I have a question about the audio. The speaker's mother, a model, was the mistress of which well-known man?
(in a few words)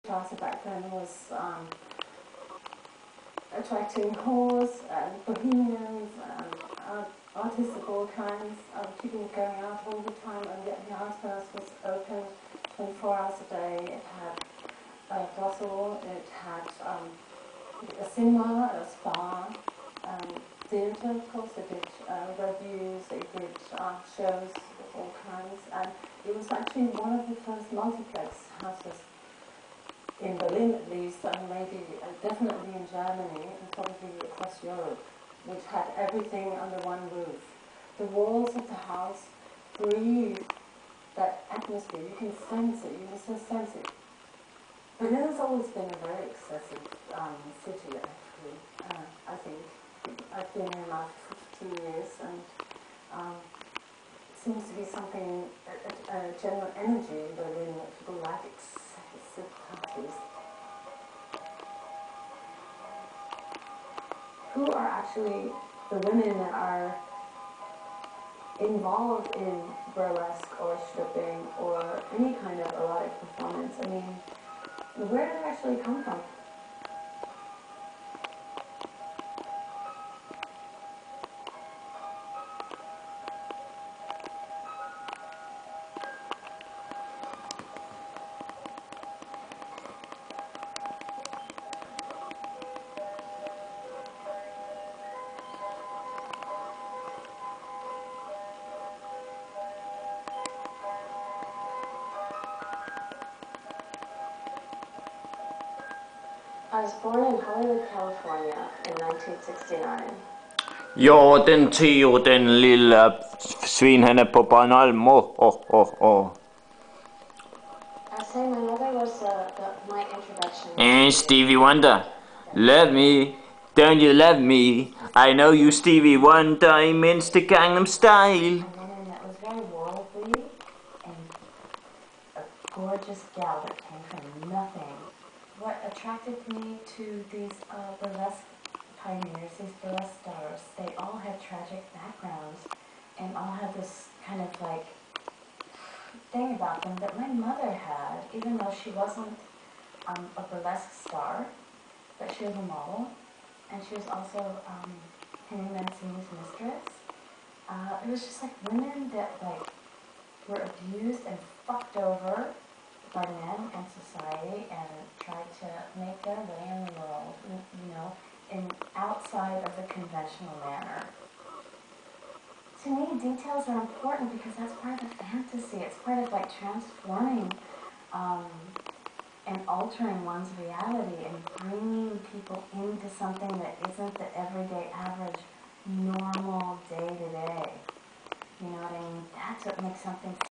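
Henry Mancini.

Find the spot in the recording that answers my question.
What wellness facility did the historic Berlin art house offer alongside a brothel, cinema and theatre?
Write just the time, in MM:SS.
00:18.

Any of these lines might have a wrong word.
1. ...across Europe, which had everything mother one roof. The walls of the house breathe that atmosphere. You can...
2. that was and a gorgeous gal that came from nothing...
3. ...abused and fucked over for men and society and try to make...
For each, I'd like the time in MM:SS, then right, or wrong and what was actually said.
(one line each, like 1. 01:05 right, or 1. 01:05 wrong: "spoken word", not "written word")
1. 00:34 wrong: "under", not "mother"
2. 02:08 right
3. 02:40 right.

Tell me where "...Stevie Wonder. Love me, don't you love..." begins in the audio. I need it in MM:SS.
02:01.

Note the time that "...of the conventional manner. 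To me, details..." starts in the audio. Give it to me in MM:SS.
02:49.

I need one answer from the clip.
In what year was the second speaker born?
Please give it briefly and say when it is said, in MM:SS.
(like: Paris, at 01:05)
1969, at 01:48.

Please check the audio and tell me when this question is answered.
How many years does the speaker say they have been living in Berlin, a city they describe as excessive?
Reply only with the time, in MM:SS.
00:51.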